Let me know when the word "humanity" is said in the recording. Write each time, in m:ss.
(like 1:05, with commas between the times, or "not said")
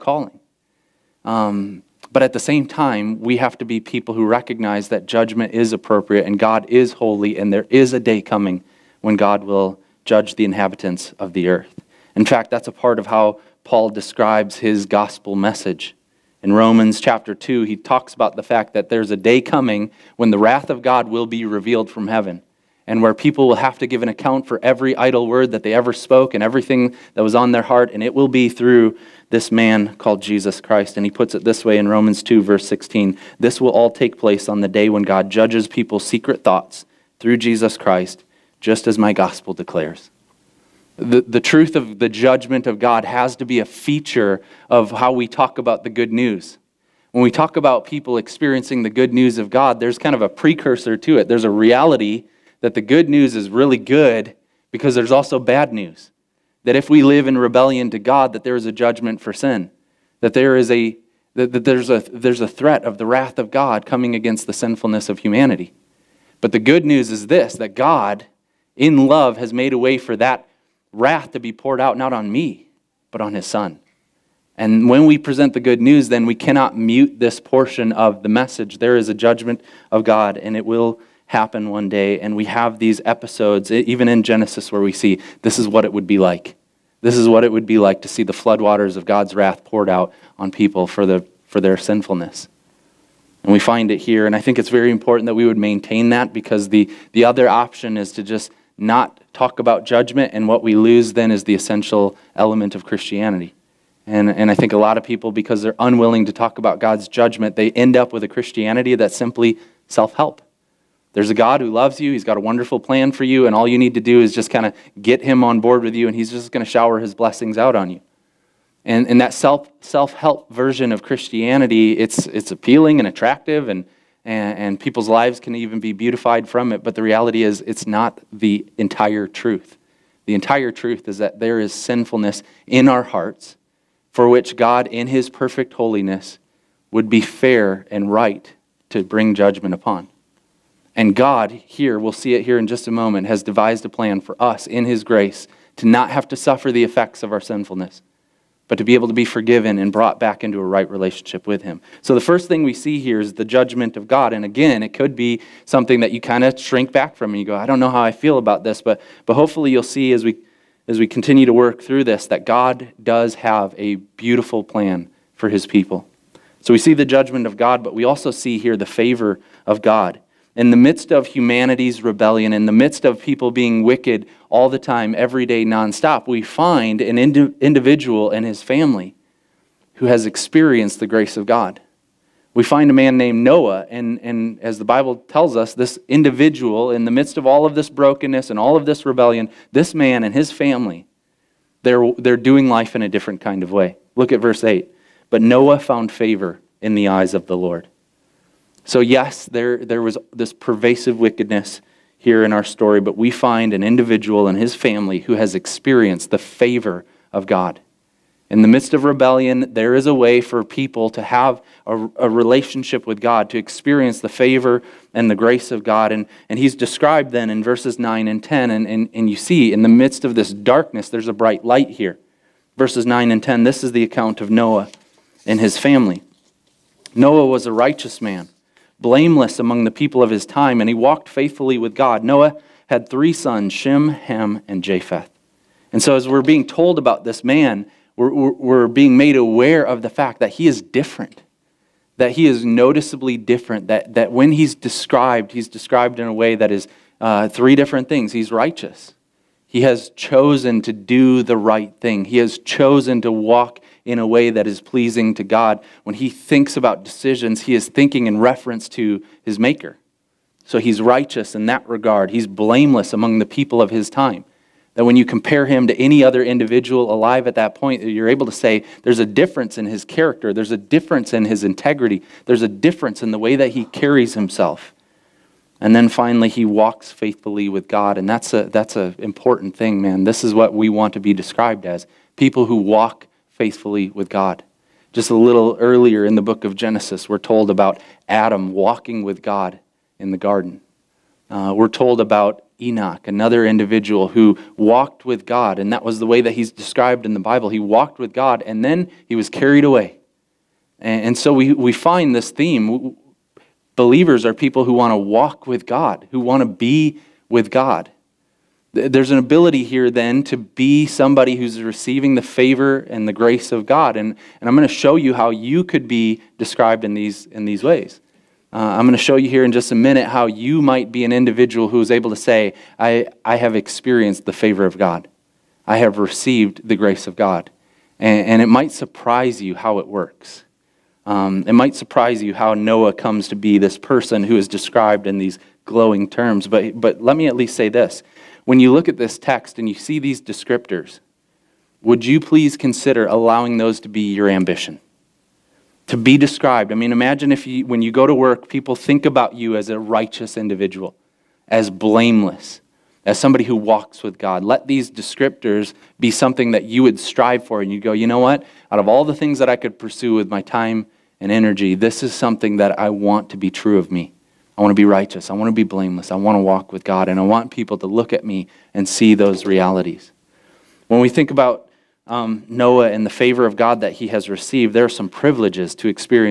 1:05, 2:51.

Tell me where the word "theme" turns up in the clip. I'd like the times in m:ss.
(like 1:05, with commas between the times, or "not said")
5:02.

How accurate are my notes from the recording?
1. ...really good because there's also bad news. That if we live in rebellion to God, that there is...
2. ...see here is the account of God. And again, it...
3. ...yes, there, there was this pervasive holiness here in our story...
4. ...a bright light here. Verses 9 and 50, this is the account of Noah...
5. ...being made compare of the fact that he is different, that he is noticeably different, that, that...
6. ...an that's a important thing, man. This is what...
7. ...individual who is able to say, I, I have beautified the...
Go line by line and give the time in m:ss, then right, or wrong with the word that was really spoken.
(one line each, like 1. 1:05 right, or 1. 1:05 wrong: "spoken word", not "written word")
1. 0:53 right
2. 2:32 wrong: "judgment", not "account"
3. 3:18 wrong: "wickedness", not "holiness"
4. 3:41 wrong: "10", not "50"
5. 3:58 wrong: "aware", not "compare"
6. 4:38 right
7. 5:21 wrong: "experienced", not "beautified".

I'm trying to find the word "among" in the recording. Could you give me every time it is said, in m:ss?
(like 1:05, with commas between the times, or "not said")
3:49, 4:23.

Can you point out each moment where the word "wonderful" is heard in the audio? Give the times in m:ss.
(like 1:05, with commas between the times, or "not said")
1:52.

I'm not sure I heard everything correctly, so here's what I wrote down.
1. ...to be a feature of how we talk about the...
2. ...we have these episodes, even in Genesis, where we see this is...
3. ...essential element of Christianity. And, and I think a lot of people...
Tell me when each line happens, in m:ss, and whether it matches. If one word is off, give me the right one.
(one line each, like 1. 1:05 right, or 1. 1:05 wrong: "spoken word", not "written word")
1. 0:43 right
2. 1:22 right
3. 1:41 right.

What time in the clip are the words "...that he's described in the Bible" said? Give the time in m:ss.
4:56.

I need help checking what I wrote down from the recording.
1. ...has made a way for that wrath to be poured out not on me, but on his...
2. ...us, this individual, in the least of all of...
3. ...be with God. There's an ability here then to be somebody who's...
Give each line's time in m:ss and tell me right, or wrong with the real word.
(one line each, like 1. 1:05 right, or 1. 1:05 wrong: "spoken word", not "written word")
1. 1:09 right
2. 3:05 wrong: "midst", not "least"
3. 5:06 right.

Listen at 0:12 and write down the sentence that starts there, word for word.
In fact, that's a part of how Paul describes his gospel message.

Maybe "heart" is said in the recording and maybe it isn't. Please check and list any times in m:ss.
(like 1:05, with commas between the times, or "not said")
0:27, 2:13.